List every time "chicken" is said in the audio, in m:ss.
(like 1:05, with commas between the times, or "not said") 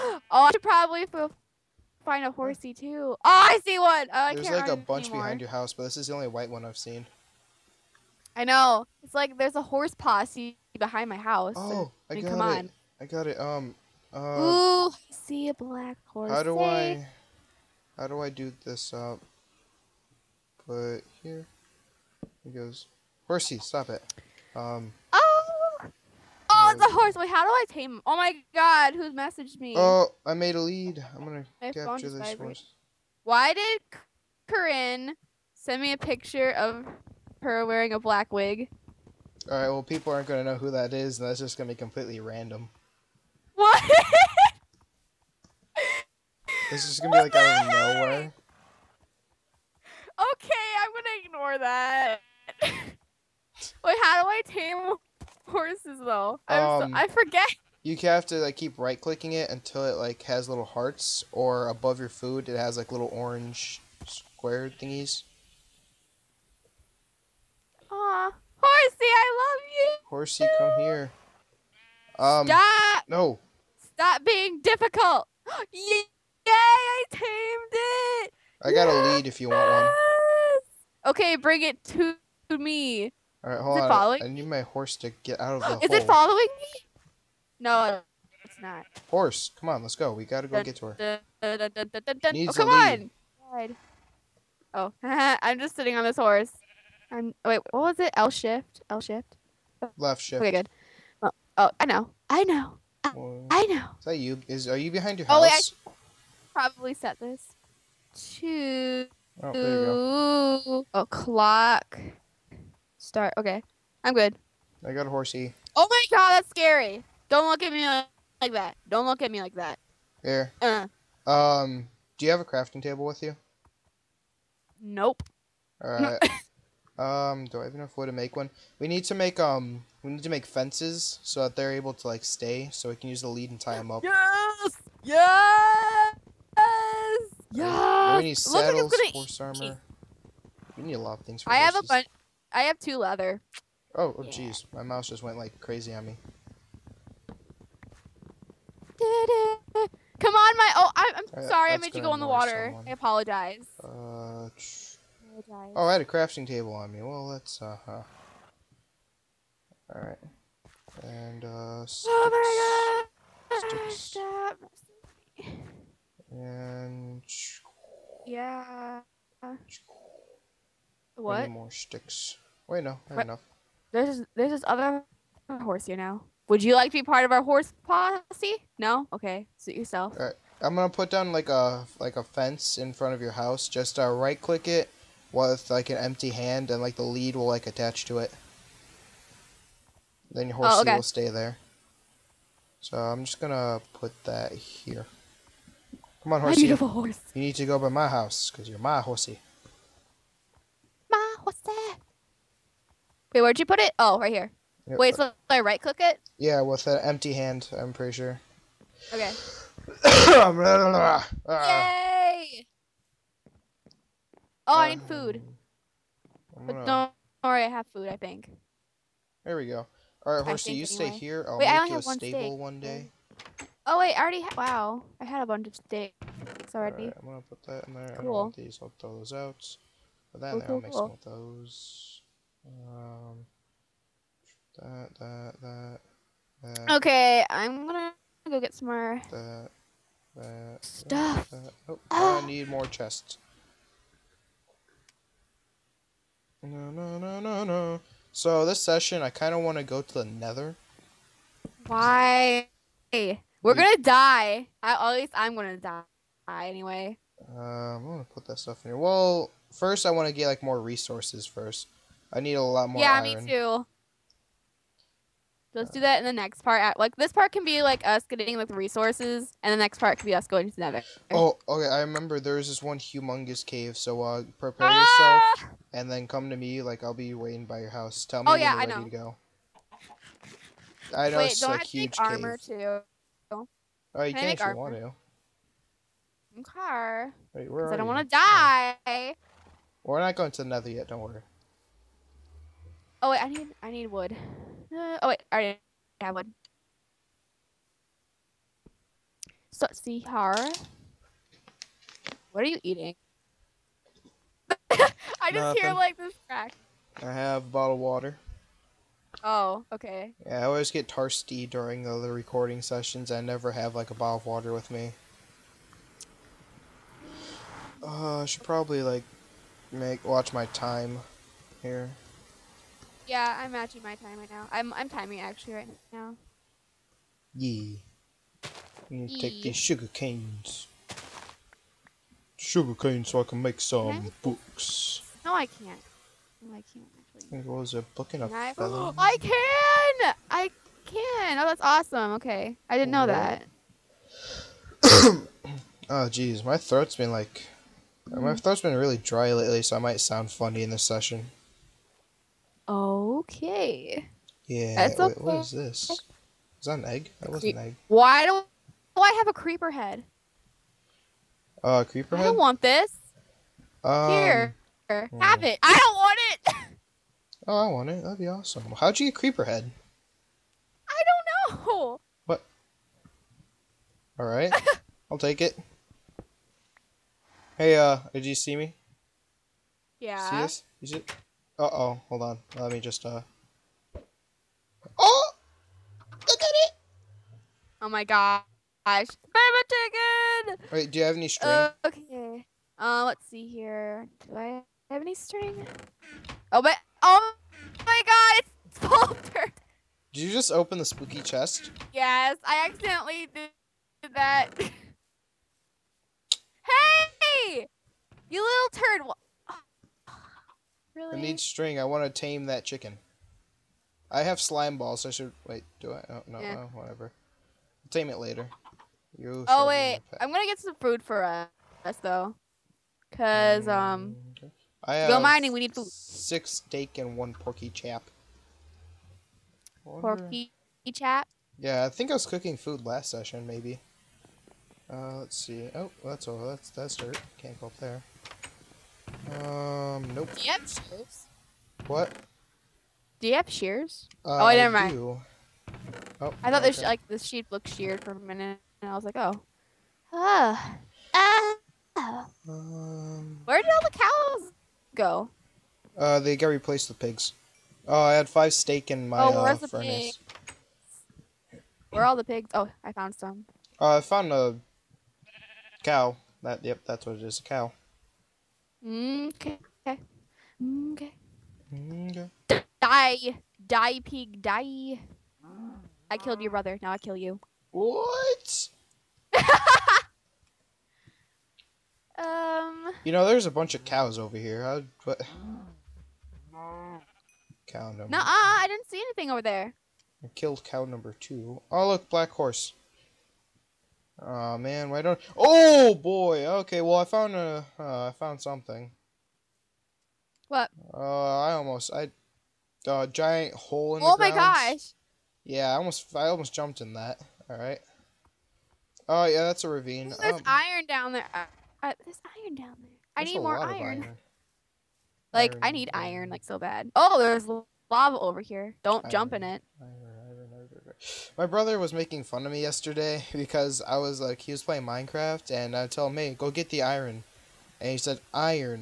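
6:29, 6:52.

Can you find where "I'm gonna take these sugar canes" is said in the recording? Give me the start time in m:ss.
5:29.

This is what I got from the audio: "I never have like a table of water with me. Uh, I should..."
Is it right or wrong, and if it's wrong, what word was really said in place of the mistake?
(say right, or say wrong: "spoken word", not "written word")
wrong: "bottle", not "table".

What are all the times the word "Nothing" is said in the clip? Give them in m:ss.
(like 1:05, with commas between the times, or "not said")
5:05.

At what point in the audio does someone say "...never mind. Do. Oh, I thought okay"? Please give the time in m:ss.
7:24.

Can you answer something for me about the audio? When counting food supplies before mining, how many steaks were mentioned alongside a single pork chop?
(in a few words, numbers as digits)
6.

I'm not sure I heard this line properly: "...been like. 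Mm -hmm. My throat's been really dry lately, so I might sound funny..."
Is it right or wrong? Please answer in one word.
right.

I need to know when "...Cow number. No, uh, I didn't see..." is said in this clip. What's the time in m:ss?
8:07.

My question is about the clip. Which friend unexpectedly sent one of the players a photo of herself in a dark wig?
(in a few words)
Corinne.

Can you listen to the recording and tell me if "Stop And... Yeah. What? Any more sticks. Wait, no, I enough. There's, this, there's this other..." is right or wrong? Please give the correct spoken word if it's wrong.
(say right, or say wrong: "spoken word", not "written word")
right.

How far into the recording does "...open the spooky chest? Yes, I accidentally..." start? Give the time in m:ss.
6:40.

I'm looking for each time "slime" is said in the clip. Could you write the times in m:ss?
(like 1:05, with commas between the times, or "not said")
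6:54.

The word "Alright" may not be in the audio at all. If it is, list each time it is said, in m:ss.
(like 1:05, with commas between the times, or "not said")
2:39, 3:00.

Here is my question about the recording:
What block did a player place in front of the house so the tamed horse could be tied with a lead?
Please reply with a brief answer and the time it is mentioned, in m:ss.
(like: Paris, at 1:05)
A fence, at 3:02.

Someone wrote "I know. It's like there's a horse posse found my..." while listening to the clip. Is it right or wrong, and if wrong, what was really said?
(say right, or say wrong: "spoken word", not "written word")
wrong: "behind", not "found".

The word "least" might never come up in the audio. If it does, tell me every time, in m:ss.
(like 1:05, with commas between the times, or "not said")
4:15.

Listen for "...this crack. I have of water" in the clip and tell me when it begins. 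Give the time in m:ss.
5:06.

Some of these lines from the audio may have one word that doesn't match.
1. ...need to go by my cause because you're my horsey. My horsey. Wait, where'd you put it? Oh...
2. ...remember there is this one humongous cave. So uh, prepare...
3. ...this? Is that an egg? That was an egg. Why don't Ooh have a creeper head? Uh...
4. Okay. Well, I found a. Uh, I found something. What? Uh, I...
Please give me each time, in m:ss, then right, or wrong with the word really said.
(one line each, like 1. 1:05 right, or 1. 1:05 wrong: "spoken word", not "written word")
1. 3:17 wrong: "house", not "cause"
2. 4:31 right
3. 5:55 wrong: "Why", not "Ooh"
4. 8:16 right.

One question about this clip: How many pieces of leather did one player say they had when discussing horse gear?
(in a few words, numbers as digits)
2.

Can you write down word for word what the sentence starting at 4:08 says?
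So this session, I kind of want to go to the nether.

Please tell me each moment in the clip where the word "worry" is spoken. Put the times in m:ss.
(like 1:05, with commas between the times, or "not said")
3:37, 4:51.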